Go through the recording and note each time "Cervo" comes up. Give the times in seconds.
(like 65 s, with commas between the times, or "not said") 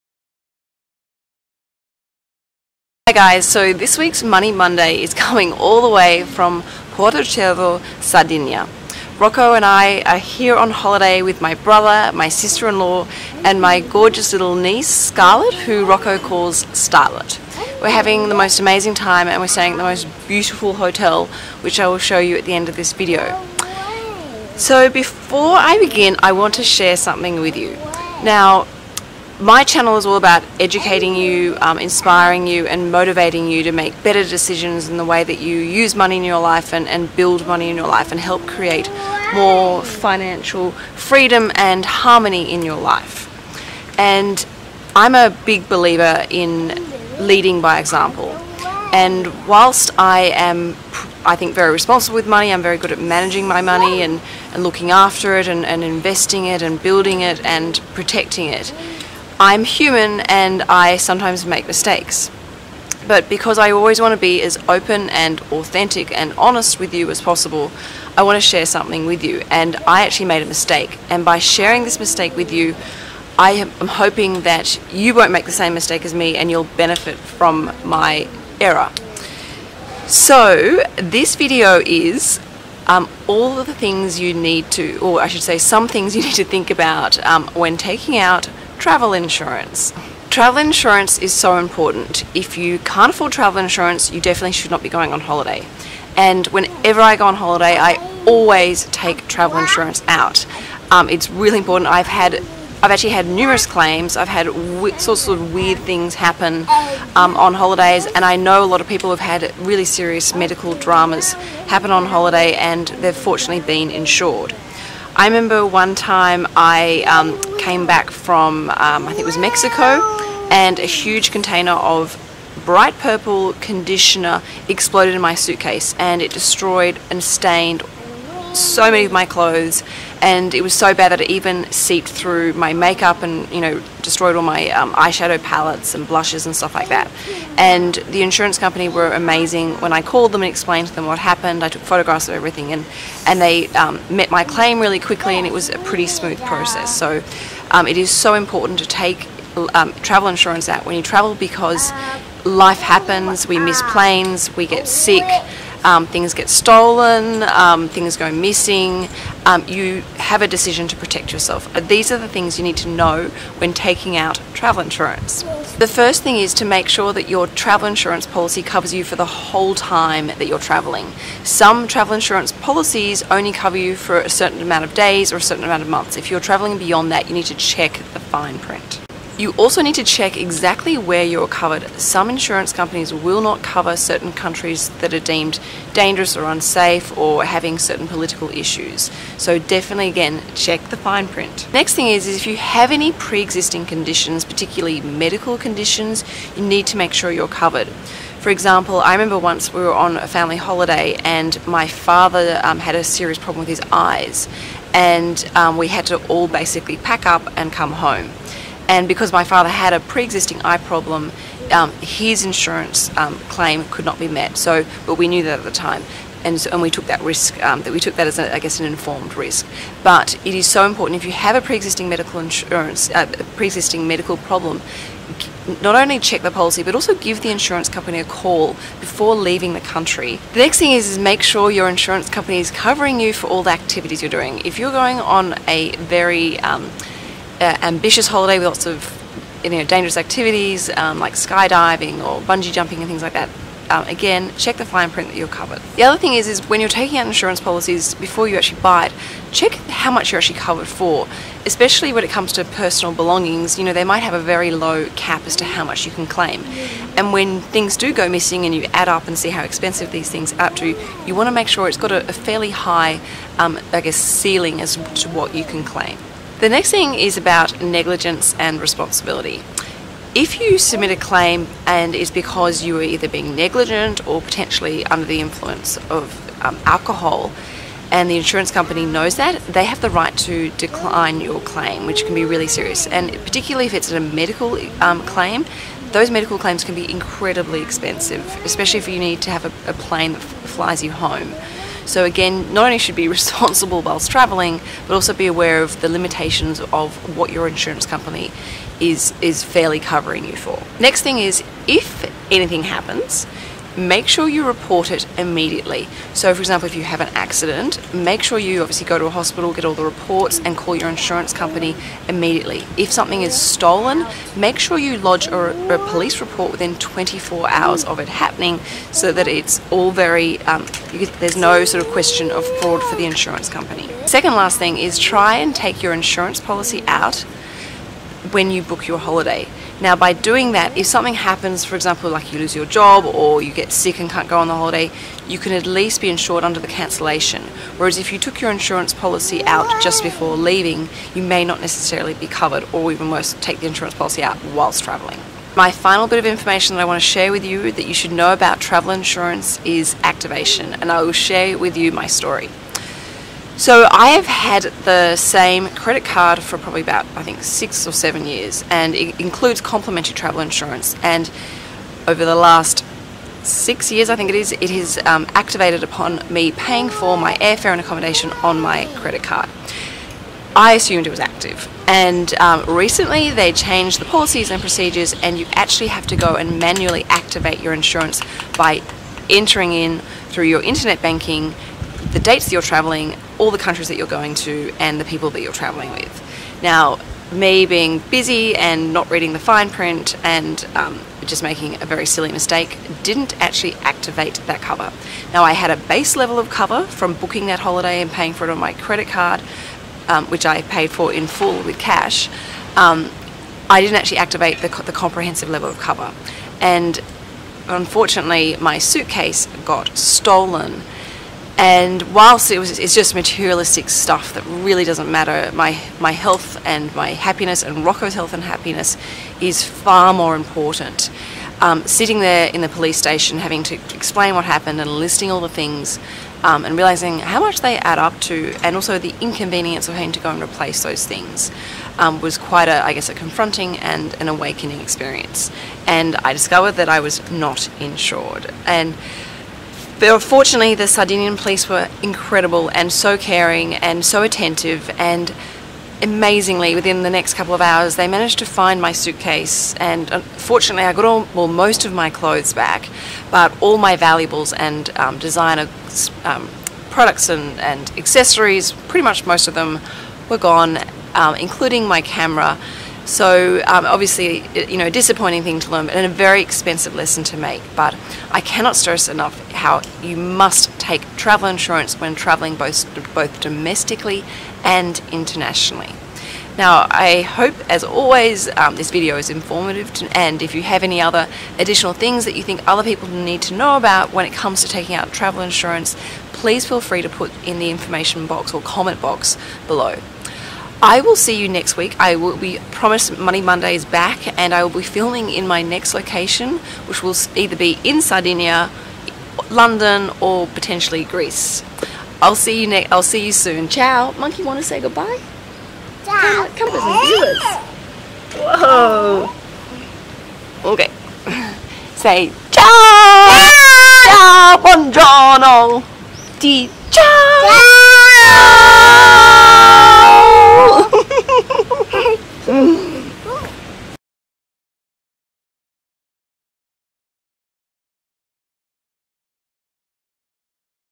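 7 s.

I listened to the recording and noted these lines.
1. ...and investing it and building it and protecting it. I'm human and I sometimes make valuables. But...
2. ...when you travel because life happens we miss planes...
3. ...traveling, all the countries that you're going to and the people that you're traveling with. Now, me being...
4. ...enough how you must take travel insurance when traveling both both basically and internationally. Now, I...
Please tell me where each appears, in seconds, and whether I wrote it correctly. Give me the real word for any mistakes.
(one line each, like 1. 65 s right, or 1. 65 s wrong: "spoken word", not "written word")
1. 55 s wrong: "mistakes", not "valuables"
2. 150 s right
3. 382 s right
4. 469 s wrong: "domestically", not "basically".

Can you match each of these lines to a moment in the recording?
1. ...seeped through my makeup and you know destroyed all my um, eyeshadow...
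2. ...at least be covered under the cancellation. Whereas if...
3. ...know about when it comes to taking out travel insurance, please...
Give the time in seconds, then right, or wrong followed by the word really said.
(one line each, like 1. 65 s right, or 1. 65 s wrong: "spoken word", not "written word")
1. 131 s right
2. 335 s wrong: "insured", not "covered"
3. 483 s right.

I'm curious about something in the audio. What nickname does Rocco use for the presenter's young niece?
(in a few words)
Starlet.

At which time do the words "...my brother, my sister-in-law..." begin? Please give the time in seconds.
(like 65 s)
11 s.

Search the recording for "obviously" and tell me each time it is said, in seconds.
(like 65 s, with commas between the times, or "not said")
308 s, 464 s.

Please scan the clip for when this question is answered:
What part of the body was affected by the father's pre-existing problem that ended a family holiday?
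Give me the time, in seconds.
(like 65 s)
203 s.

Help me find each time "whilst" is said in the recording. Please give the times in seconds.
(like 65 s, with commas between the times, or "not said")
49 s, 294 s, 344 s, 412 s.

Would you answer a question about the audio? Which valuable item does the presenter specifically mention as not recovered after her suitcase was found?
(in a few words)
Camera.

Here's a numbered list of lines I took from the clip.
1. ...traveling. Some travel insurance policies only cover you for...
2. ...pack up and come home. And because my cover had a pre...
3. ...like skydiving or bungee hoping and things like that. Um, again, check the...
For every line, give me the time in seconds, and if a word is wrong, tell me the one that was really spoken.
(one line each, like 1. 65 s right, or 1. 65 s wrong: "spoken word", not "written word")
1. 170 s right
2. 206 s wrong: "father", not "cover"
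3. 241 s wrong: "jumping", not "hoping".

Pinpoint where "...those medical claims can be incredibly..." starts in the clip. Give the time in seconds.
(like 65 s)
286 s.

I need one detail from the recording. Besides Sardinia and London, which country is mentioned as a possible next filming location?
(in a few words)
Greece.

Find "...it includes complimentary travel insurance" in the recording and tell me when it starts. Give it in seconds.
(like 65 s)
359 s.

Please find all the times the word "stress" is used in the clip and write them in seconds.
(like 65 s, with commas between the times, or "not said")
468 s.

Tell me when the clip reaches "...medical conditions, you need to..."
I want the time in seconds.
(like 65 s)
195 s.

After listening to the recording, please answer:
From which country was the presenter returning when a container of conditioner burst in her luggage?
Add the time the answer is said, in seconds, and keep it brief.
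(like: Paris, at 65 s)
Mexico, at 119 s.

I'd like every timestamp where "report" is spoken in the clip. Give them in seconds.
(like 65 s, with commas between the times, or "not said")
304 s, 310 s, 316 s.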